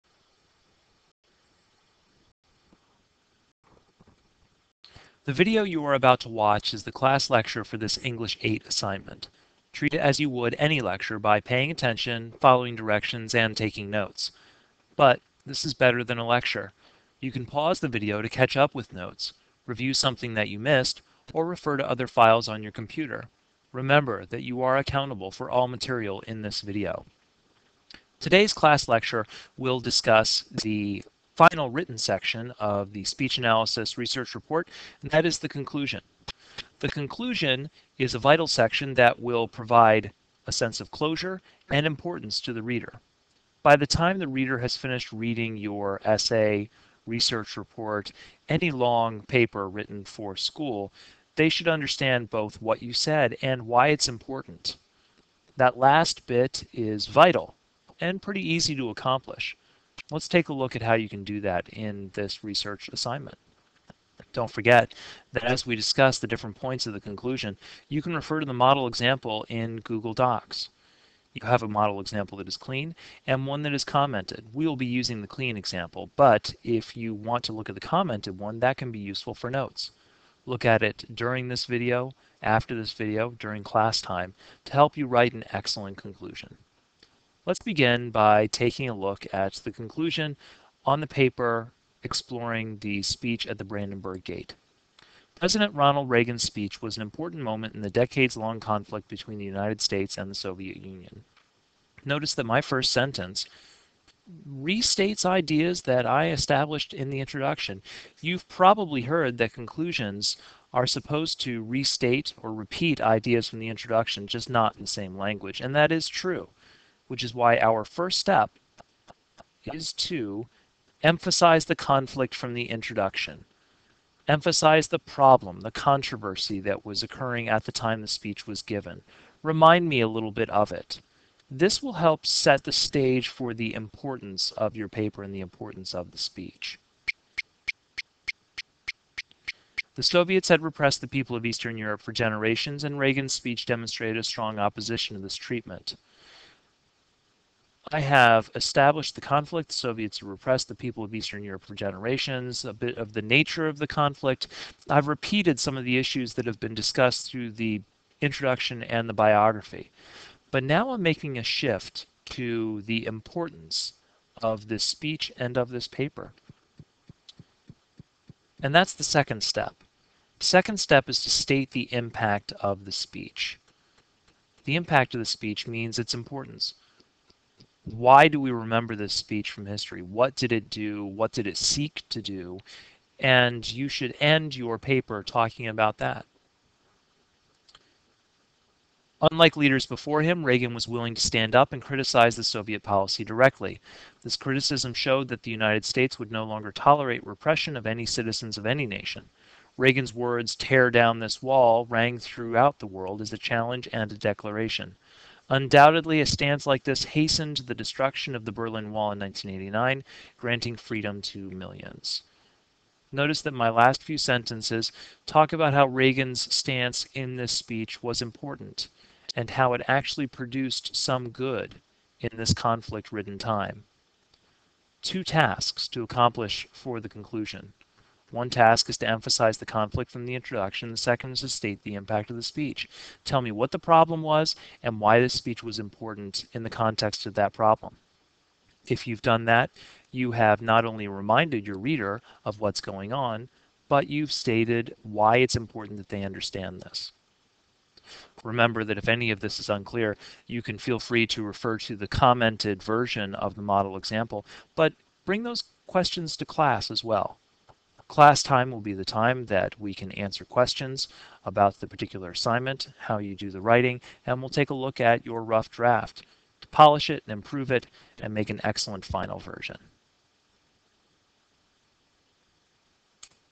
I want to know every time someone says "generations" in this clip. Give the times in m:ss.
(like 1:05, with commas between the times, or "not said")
2:22, 2:31.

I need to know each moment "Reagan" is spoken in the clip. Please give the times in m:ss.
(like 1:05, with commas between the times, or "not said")
1:36, 2:22, 3:10, 3:19, 3:35.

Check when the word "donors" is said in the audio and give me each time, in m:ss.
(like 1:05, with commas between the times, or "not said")
not said.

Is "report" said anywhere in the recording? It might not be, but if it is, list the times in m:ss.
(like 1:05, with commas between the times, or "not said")
0:34, 0:47.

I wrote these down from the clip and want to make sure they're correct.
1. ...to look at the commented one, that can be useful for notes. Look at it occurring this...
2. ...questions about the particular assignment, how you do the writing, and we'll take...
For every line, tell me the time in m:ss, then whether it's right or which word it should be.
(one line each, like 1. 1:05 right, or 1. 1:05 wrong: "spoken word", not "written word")
1. 1:17 wrong: "during", not "occurring"
2. 4:20 right.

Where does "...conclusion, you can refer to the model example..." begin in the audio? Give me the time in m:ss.
1:06.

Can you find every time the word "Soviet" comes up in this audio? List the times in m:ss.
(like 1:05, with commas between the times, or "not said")
1:40, 2:20, 2:29, 3:12.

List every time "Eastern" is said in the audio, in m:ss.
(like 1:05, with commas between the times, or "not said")
2:21, 2:31.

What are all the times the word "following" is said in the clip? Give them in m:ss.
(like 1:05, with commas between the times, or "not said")
0:12.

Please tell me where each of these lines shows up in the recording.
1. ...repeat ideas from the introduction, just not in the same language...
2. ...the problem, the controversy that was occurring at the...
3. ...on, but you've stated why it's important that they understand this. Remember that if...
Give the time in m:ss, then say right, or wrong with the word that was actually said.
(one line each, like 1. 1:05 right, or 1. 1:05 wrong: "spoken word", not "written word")
1. 1:52 right
2. 2:04 right
3. 4:03 right.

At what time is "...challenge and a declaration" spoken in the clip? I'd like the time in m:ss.
3:23.